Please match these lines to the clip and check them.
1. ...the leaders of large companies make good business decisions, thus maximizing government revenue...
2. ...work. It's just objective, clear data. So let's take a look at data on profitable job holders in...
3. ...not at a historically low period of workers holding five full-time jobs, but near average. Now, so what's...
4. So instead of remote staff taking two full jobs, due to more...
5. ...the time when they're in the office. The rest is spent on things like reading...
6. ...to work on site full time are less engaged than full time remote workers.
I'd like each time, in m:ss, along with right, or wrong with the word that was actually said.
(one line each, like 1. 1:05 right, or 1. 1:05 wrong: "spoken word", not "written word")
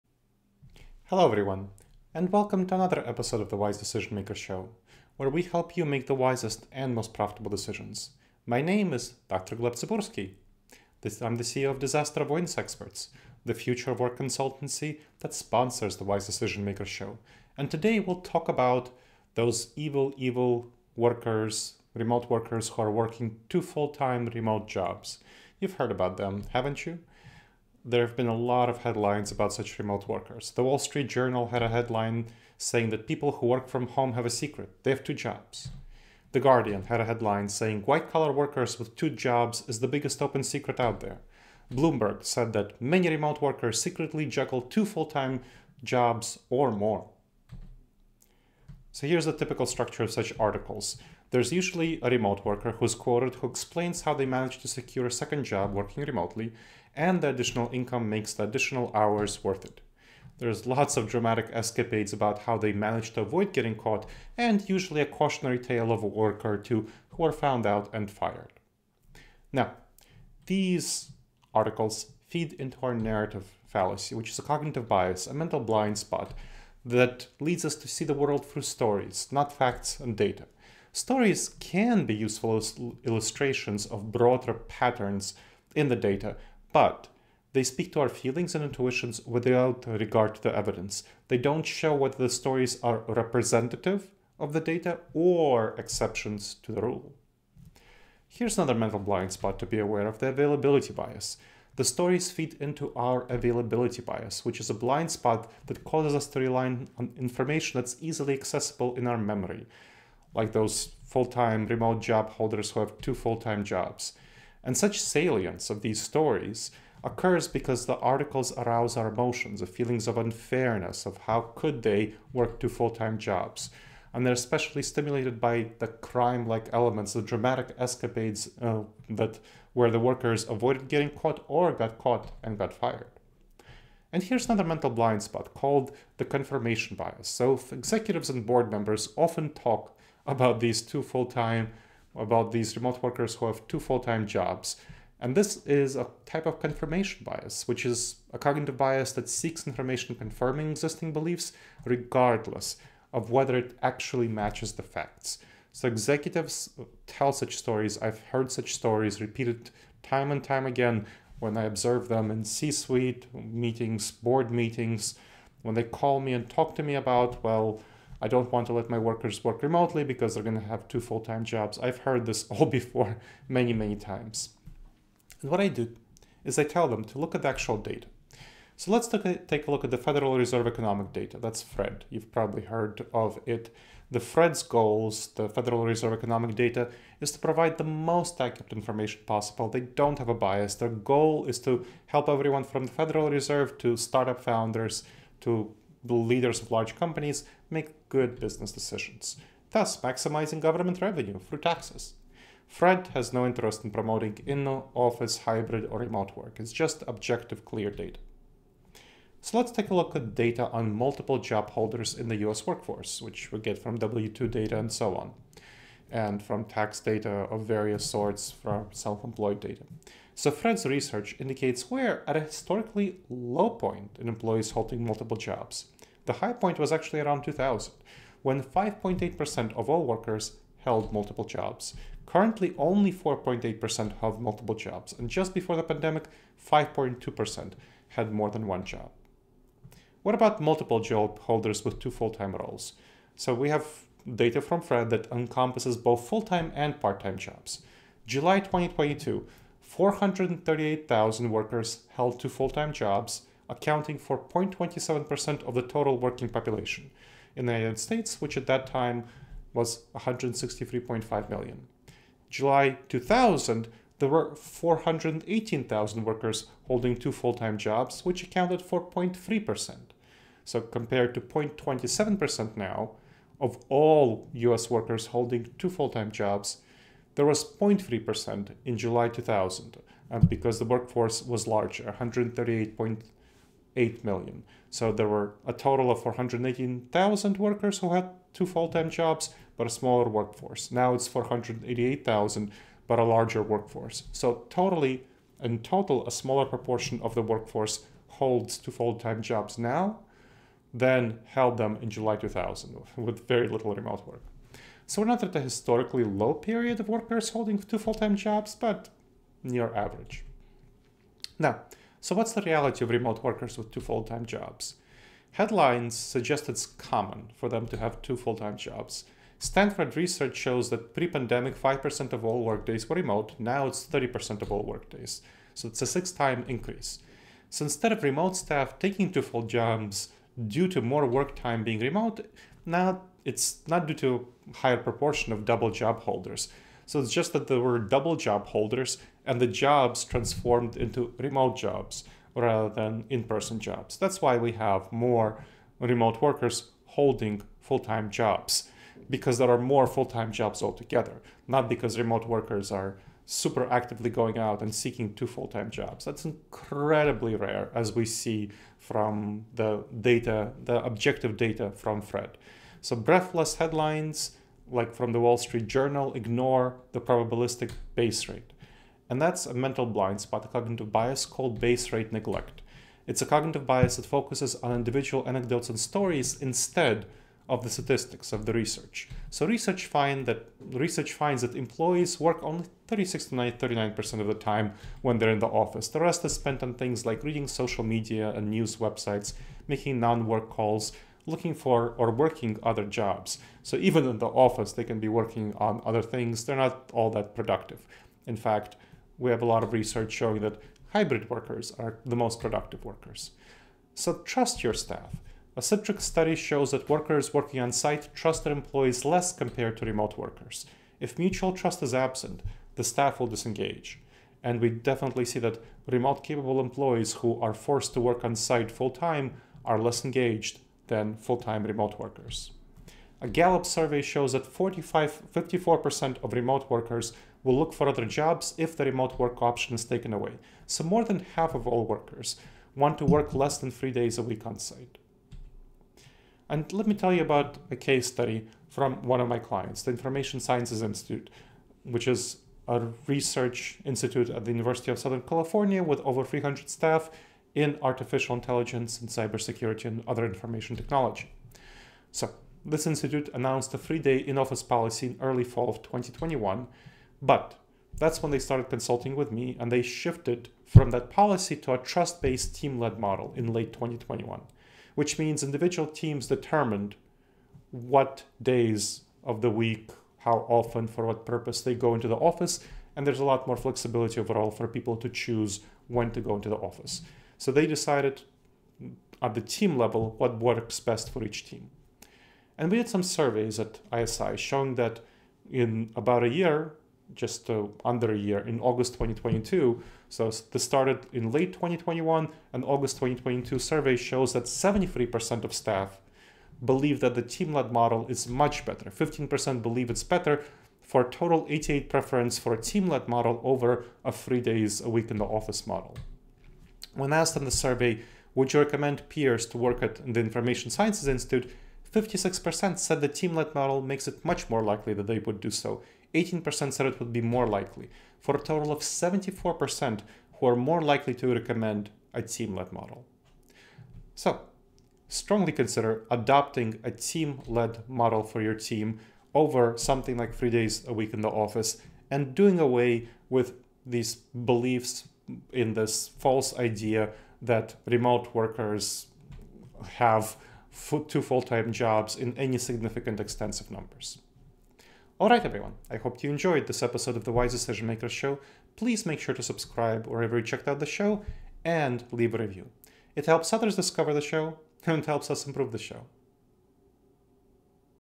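1. 3:16 right
2. 3:26 wrong: "multiple", not "profitable"
3. 5:05 wrong: "two", not "five"
4. 5:27 right
5. 6:24 right
6. 6:58 right.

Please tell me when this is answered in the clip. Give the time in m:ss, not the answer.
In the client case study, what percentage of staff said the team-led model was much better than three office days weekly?
8:14.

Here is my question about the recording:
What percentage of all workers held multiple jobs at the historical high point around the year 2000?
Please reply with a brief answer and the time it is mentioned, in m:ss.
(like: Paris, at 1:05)
5.8%, at 3:48.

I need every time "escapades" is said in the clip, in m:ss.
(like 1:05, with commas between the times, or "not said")
1:01, 2:07.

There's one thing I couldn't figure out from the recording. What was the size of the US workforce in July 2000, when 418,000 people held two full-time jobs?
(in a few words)
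138.8 million.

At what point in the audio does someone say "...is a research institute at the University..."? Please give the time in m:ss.
7:22.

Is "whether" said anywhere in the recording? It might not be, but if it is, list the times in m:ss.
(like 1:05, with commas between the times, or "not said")
1:31, 2:33.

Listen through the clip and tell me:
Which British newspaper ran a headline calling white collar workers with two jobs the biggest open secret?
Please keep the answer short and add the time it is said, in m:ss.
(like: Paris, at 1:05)
The Guardian, at 0:36.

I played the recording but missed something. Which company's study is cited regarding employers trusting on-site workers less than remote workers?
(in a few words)
Citrix.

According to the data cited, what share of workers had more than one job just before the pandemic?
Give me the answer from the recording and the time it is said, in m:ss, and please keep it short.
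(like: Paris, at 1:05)
5.2%, at 3:56.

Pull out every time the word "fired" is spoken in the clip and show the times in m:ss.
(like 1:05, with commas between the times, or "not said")
1:08, 2:12.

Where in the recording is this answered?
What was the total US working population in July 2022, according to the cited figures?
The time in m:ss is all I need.
4:20.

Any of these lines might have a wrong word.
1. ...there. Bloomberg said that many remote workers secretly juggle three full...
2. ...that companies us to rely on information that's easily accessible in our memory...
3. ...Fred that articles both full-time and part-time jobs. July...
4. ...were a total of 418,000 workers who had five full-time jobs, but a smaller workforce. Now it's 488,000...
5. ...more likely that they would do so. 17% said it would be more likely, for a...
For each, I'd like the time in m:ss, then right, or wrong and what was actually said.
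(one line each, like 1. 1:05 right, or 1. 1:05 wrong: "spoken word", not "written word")
1. 0:40 wrong: "two", not "three"
2. 1:45 wrong: "causes", not "companies"
3. 4:04 wrong: "encompasses", not "articles"
4. 4:45 wrong: "two", not "five"
5. 8:34 wrong: "18", not "17".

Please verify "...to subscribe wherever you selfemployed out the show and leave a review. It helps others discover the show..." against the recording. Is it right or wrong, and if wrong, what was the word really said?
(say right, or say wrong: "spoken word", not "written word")
wrong: "checked", not "selfemployed".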